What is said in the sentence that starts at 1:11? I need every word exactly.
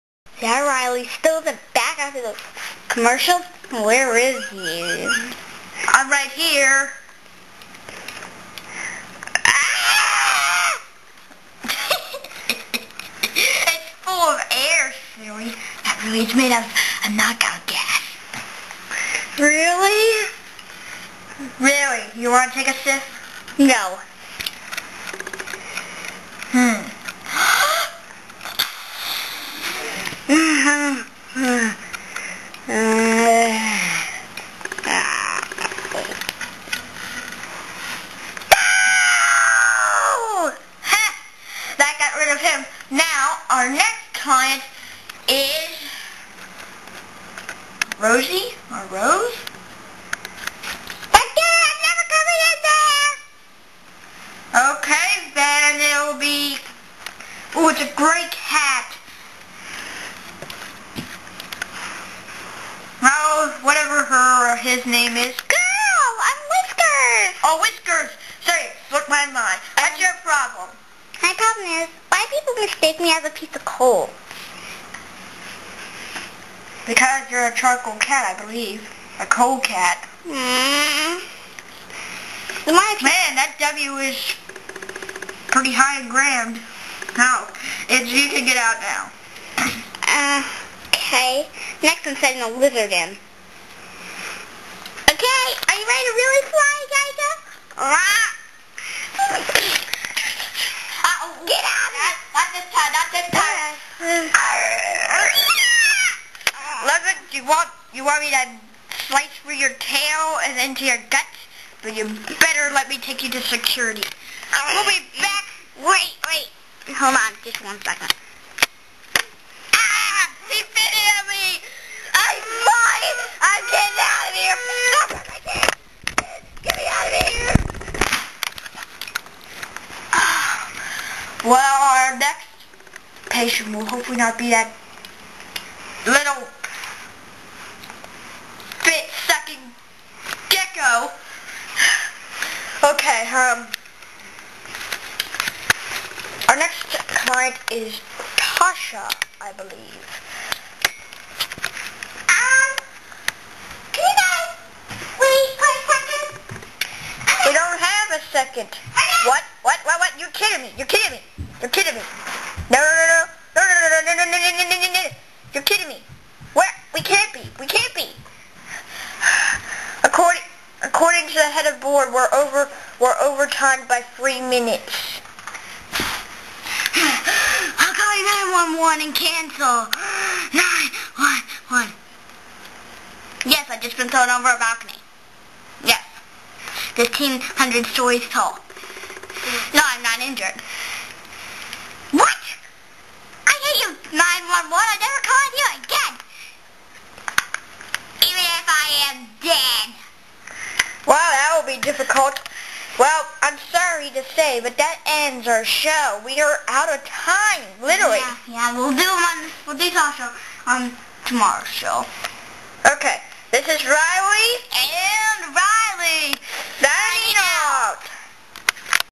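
My problem is, why people mistake me as a piece of coal.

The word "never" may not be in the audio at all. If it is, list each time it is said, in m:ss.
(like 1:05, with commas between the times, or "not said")
0:51, 3:15.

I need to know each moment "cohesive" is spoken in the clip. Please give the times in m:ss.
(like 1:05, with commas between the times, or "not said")
not said.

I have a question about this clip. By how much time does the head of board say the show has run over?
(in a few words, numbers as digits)
3 minutes.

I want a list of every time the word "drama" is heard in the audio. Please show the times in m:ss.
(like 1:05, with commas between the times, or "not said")
not said.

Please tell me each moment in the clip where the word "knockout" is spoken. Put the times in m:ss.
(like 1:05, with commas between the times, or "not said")
0:17.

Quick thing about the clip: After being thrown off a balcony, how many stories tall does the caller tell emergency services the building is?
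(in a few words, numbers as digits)
1,500.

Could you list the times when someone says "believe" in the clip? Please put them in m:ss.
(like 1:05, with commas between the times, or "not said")
1:18, 2:29.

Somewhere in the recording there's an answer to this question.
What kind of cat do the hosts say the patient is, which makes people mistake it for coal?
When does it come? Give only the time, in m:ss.
1:17.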